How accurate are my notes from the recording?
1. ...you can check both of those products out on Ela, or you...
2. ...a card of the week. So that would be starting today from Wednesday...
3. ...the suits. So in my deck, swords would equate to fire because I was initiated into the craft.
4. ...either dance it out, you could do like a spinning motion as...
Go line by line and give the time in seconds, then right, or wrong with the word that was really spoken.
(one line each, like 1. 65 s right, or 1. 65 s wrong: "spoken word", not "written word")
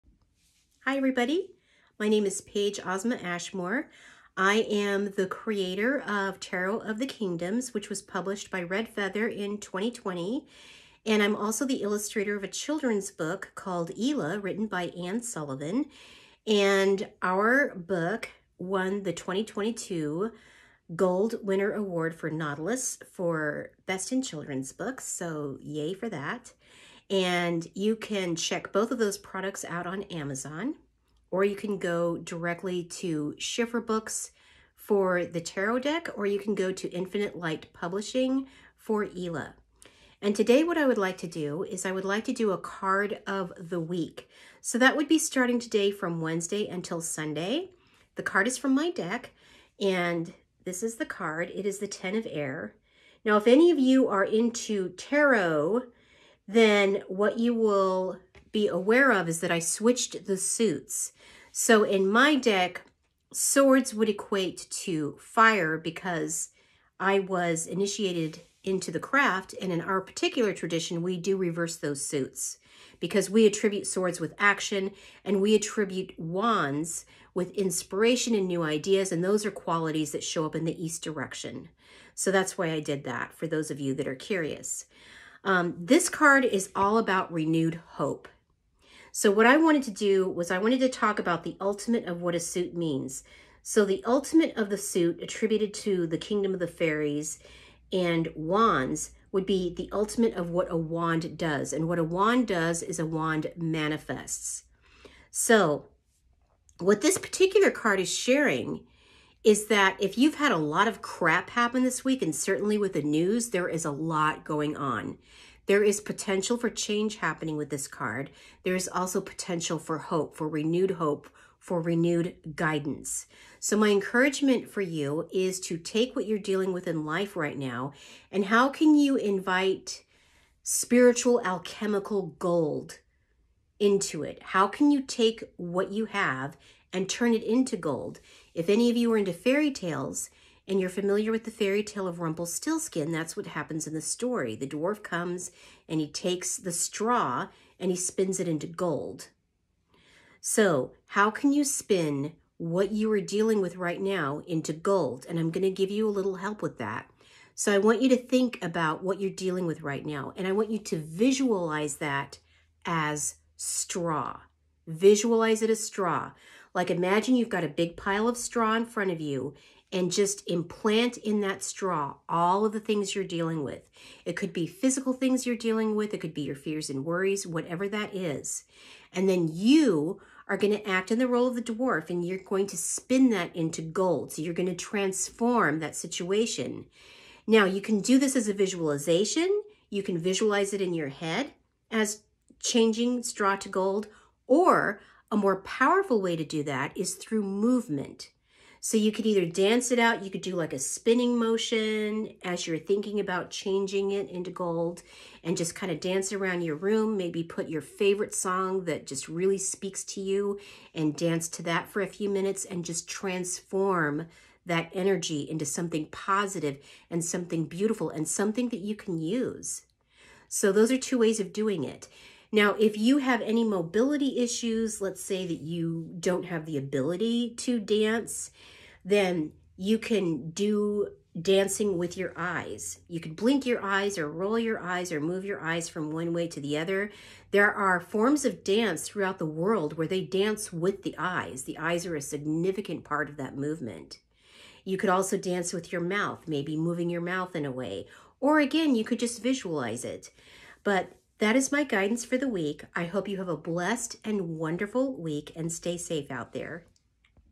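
1. 27 s wrong: "Amazon", not "Ela"
2. 42 s right
3. 60 s right
4. 199 s right.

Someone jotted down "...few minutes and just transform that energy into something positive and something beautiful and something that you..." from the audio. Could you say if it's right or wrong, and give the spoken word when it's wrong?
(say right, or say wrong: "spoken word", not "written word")
right.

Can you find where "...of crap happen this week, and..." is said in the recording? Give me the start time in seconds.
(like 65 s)
110 s.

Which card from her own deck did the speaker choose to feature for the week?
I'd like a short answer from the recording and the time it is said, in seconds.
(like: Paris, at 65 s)
Ten of Air, at 51 s.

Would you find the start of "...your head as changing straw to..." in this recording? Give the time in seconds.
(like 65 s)
190 s.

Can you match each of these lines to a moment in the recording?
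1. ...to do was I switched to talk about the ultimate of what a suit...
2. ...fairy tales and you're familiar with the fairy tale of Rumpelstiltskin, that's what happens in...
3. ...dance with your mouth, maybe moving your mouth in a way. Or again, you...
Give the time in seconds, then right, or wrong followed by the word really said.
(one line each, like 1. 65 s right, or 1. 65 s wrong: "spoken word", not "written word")
1. 89 s wrong: "wanted", not "switched"
2. 139 s right
3. 245 s right.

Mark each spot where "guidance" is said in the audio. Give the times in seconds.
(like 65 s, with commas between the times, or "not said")
122 s, 251 s.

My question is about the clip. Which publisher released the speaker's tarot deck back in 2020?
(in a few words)
Red Feather.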